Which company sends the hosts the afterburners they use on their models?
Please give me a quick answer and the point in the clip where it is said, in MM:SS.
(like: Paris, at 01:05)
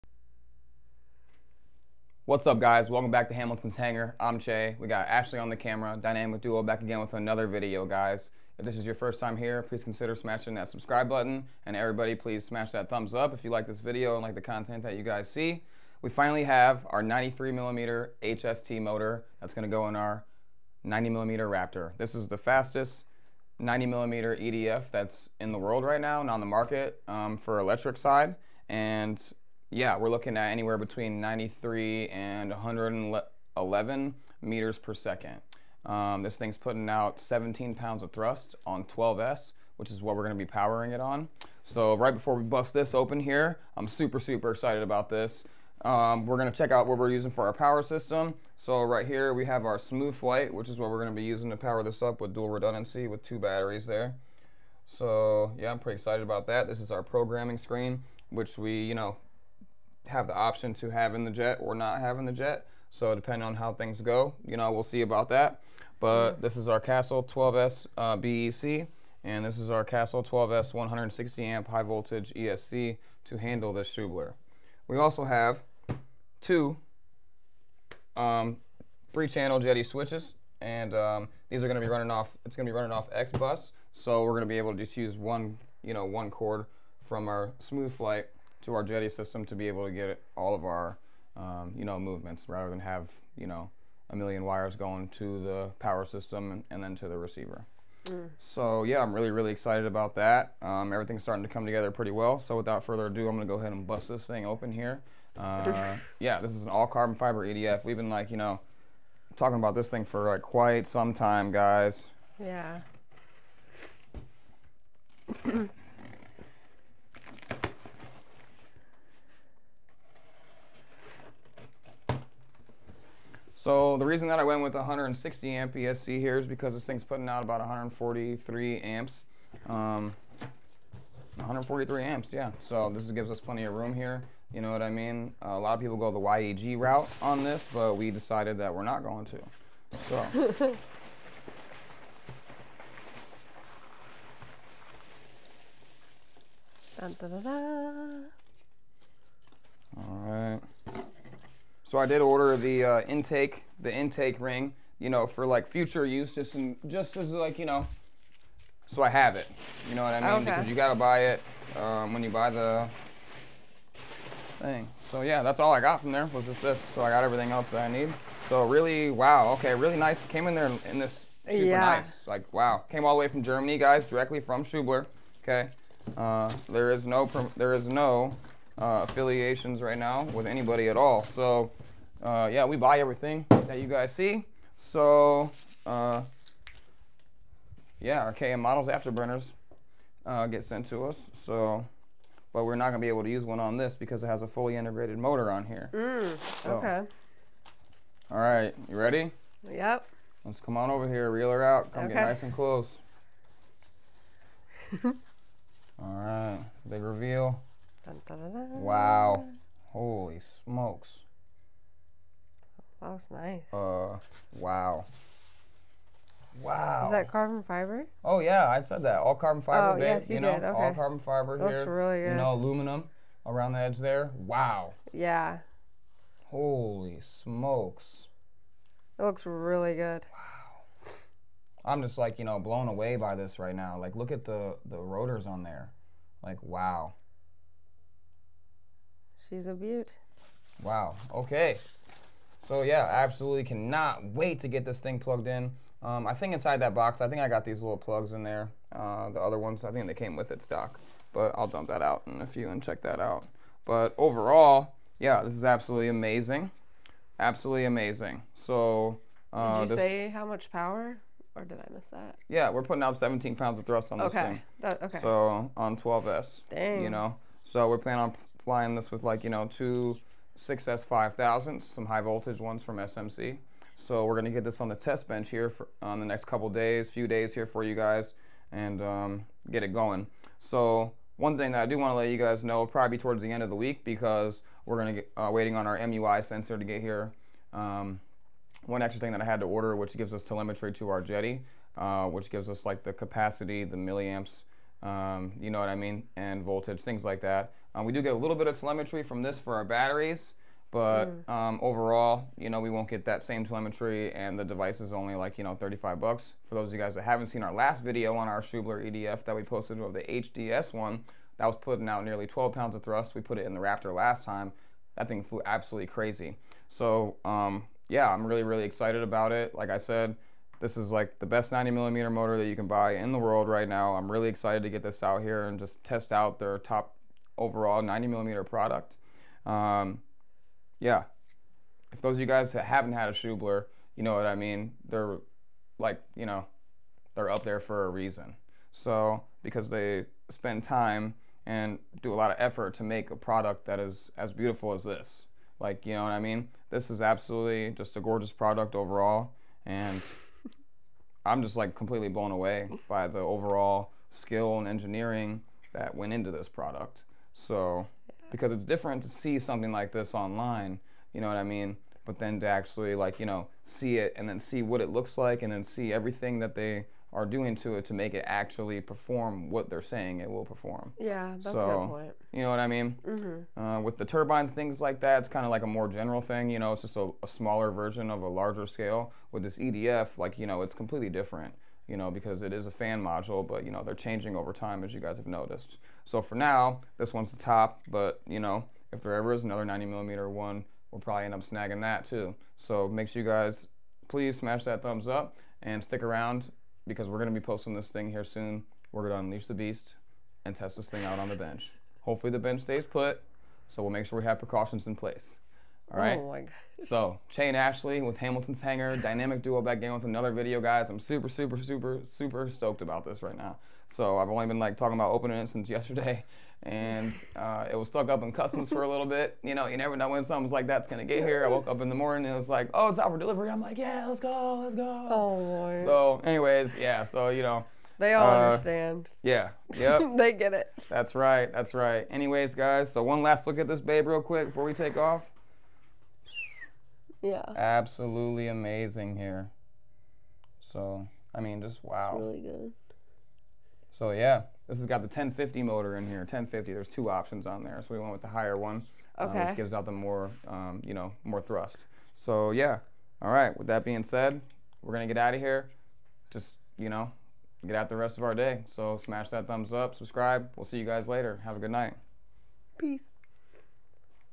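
KM models, at 03:08.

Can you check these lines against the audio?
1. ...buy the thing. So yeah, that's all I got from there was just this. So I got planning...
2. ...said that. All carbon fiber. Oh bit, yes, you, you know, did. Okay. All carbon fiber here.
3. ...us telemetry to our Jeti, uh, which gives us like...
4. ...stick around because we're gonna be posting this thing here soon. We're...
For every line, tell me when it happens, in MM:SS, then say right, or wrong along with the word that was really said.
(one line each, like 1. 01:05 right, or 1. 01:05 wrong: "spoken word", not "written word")
1. 02:42 wrong: "everything", not "planning"
2. 03:38 right
3. 04:50 right
4. 06:36 right.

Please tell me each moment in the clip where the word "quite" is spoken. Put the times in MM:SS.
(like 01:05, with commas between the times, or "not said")
01:50.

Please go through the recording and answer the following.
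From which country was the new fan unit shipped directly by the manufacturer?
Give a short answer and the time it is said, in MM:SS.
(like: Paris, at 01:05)
Germany, at 02:53.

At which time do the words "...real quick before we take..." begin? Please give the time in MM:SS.
07:14.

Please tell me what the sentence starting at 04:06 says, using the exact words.
Um, I think inside that box, I think I got these little plugs in there.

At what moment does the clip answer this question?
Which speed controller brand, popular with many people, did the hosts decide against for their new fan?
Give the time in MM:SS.
02:16.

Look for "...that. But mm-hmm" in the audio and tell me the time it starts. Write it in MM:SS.
01:05.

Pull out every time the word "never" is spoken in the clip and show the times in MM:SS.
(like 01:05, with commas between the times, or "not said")
06:59.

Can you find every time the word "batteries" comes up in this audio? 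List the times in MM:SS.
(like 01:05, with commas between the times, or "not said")
00:53, 04:59.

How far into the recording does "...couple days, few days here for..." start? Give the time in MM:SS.
04:36.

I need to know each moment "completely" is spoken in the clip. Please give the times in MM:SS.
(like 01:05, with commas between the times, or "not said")
05:51, 06:20.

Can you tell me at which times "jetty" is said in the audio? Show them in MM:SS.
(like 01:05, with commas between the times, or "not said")
01:28.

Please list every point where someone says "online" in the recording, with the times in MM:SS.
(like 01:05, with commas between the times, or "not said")
06:00.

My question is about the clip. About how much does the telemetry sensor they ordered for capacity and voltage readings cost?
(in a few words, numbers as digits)
$35.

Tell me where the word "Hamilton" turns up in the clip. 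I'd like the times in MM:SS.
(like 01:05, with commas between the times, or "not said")
00:03, 06:48.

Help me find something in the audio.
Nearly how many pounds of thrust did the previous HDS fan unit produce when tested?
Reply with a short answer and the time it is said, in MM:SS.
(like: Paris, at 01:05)
12 pounds, at 05:12.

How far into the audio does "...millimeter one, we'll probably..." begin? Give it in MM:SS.
06:30.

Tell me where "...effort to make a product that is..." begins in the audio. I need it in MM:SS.
05:42.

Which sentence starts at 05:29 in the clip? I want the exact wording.
Um, yeah, if those of you guys that haven't had a Schubeler, you know what I mean.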